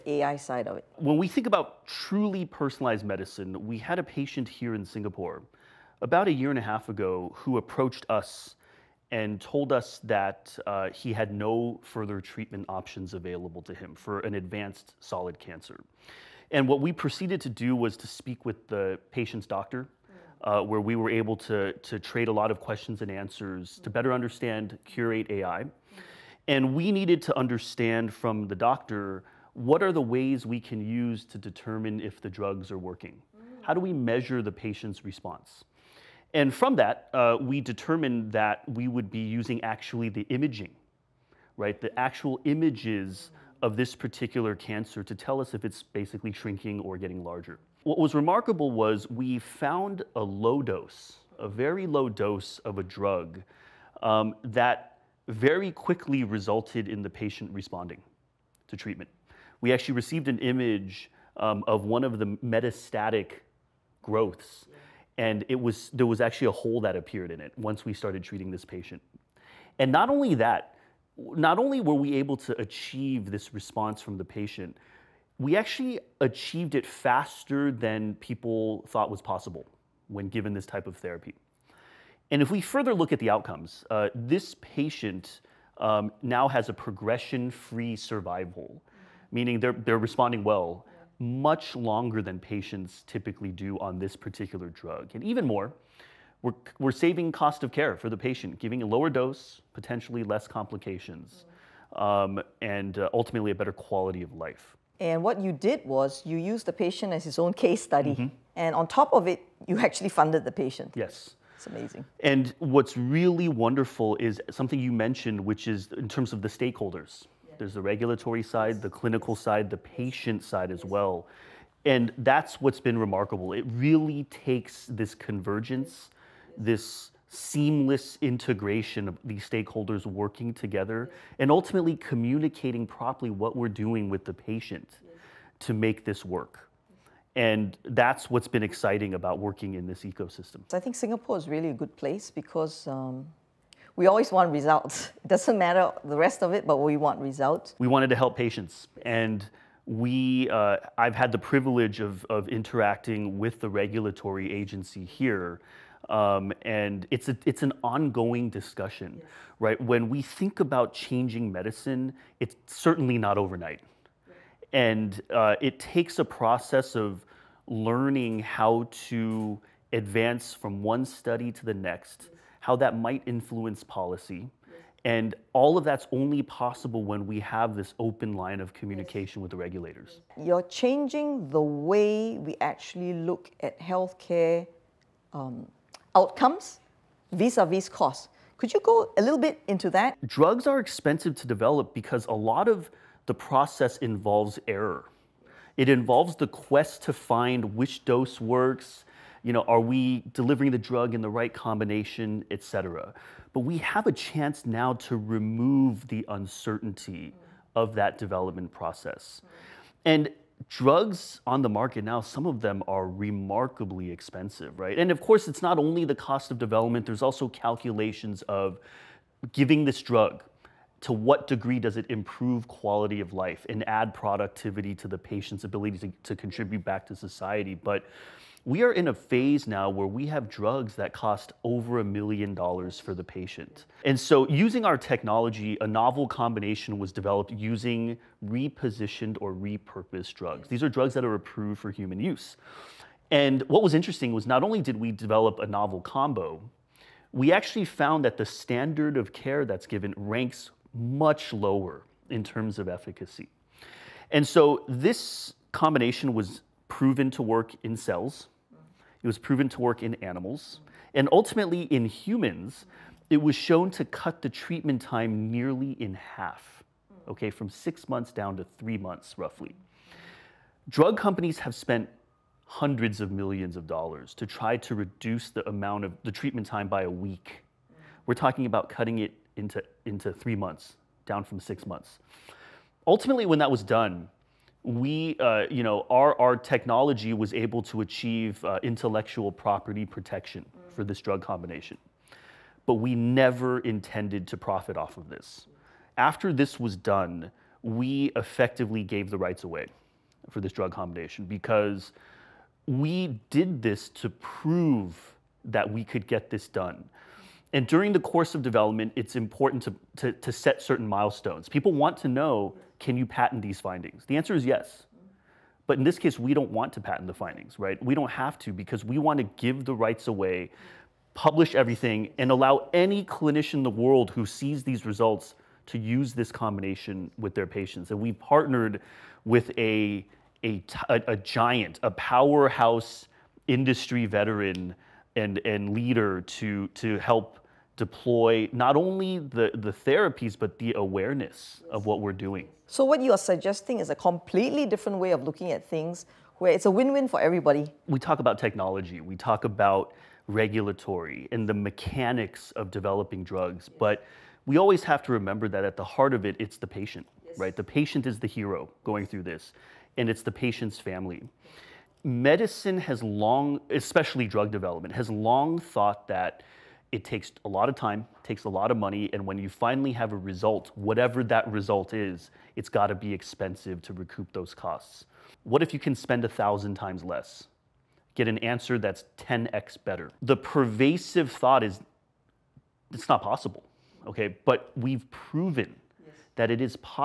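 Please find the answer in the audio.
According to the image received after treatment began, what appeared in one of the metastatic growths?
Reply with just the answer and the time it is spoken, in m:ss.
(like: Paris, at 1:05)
a hole, at 1:06.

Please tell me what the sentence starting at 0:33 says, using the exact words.
How do we measure the patient's response?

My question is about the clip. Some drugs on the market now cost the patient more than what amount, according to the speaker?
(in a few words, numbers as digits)
a million dollars.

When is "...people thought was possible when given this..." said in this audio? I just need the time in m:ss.
1:18.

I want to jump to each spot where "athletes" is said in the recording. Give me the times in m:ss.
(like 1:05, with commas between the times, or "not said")
not said.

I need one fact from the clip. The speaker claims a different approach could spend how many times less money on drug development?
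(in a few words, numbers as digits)
1000 times.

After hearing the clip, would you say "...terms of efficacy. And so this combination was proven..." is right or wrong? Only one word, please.
right.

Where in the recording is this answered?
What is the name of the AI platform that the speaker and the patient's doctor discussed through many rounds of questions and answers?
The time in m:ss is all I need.
0:24.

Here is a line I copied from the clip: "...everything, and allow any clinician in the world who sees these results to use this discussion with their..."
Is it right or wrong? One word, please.
wrong.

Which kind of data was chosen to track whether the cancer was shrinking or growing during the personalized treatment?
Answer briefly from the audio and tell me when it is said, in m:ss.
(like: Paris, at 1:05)
imaging, at 0:40.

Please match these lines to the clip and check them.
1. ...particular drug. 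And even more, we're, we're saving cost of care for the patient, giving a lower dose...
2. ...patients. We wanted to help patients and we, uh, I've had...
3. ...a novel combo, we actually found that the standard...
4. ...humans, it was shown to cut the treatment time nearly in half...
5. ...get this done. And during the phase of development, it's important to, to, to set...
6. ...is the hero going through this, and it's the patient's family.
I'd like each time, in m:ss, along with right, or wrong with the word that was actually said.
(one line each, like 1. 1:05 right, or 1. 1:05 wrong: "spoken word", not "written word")
1. 1:34 right
2. 2:27 wrong: "results", not "patients"
3. 4:05 right
4. 4:22 right
5. 5:06 wrong: "course", not "phase"
6. 5:58 right.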